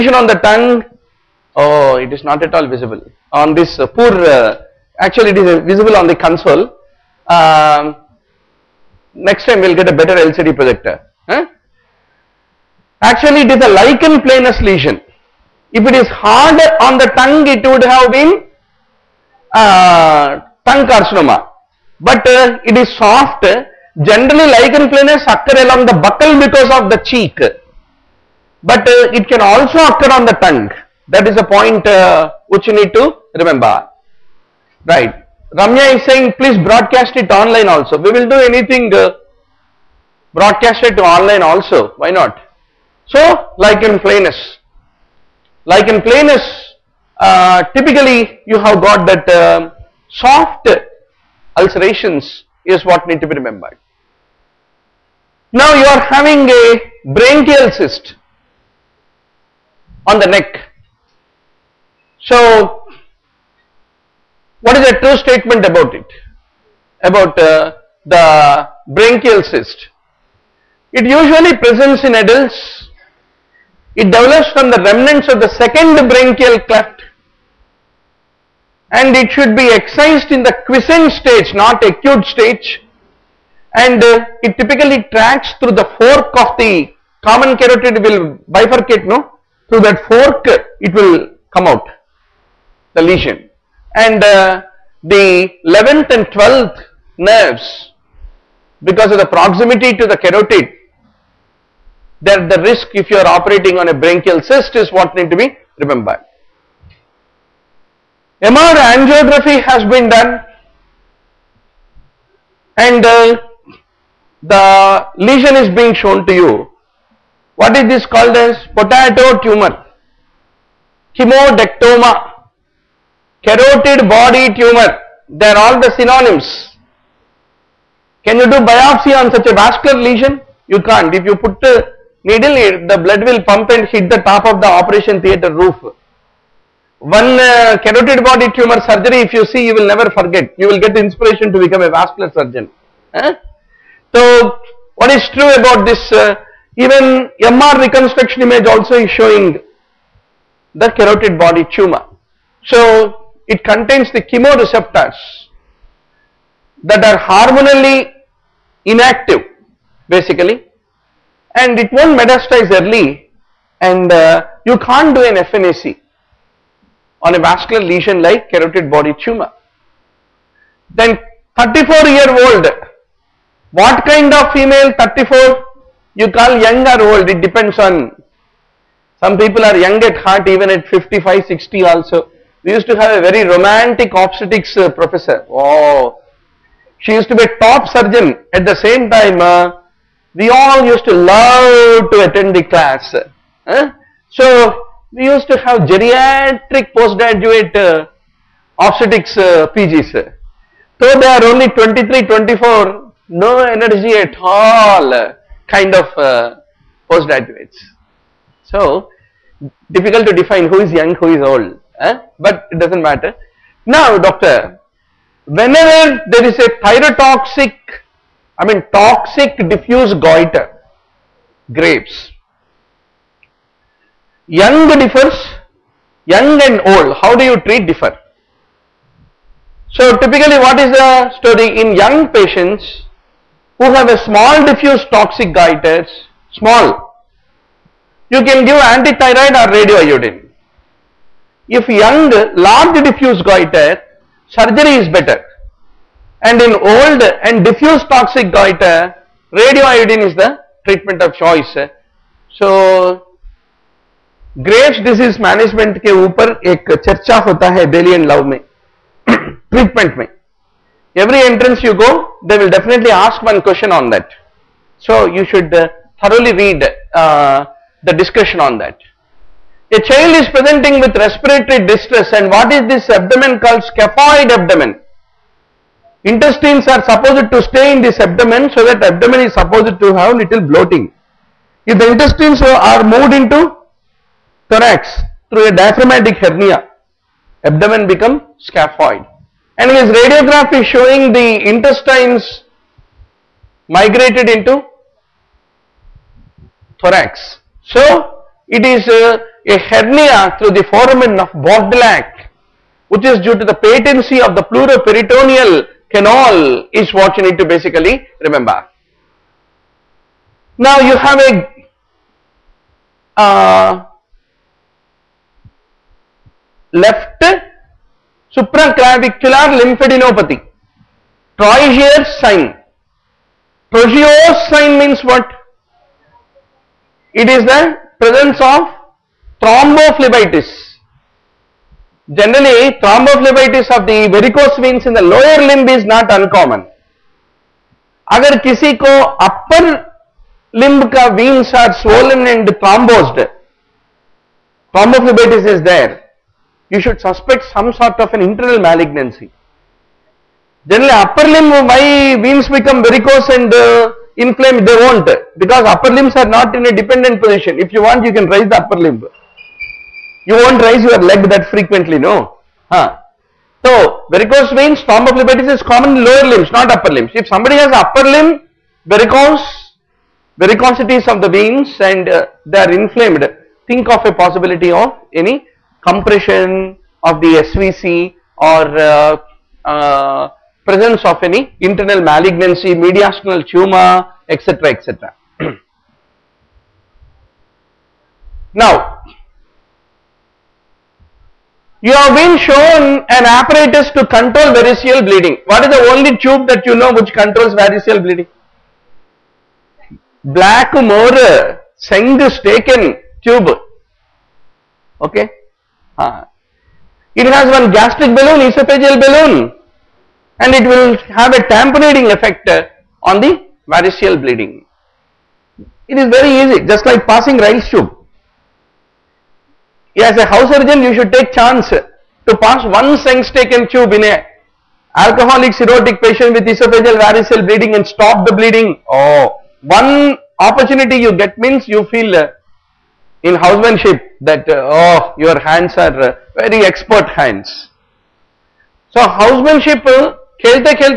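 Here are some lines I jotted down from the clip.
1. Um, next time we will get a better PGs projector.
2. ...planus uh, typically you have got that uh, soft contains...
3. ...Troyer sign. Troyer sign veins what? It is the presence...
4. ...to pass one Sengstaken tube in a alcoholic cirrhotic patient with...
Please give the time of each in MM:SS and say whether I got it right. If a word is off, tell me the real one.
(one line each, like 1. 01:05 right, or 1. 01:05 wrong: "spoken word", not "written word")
1. 00:07 wrong: "LCD", not "PGs"
2. 00:46 wrong: "ulcerations", not "contains"
3. 05:21 wrong: "means", not "veins"
4. 07:01 right.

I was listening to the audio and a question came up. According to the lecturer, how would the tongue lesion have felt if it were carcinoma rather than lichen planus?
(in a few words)
Harder.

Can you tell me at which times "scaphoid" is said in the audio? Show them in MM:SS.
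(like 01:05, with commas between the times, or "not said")
04:33, 04:48.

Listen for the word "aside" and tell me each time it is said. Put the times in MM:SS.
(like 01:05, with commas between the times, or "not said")
not said.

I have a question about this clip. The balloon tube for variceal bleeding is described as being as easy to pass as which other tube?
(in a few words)
Ryle's tube.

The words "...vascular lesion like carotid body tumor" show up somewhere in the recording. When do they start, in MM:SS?
02:47.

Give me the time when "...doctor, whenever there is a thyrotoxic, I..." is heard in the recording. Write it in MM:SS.
03:34.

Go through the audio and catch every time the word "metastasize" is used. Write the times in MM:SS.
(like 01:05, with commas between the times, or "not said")
02:42.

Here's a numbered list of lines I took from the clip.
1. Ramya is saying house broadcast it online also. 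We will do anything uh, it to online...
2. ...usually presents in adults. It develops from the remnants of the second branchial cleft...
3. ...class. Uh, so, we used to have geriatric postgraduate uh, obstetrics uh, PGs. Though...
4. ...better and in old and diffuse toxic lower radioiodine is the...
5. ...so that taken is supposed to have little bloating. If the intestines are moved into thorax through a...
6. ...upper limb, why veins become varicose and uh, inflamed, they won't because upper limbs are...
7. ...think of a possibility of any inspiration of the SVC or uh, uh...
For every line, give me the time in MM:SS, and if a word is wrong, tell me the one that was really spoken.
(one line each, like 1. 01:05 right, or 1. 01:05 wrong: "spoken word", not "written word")
1. 00:35 wrong: "please", not "house"
2. 01:11 right
3. 03:12 right
4. 04:05 wrong: "goiter", not "lower"
5. 04:38 wrong: "abdomen", not "taken"
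6. 05:51 right
7. 06:13 wrong: "compression", not "inspiration".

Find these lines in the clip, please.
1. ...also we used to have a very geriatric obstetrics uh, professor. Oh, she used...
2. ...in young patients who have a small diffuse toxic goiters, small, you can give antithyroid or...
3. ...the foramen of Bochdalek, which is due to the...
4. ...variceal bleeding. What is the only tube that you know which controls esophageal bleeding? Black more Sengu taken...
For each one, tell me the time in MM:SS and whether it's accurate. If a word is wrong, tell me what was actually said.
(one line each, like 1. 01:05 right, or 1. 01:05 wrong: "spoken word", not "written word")
1. 03:01 wrong: "romantic", not "geriatric"
2. 03:51 right
3. 05:00 right
4. 06:34 wrong: "variceal", not "esophageal".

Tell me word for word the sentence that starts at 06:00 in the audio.
You won't raise your leg that frequently, no.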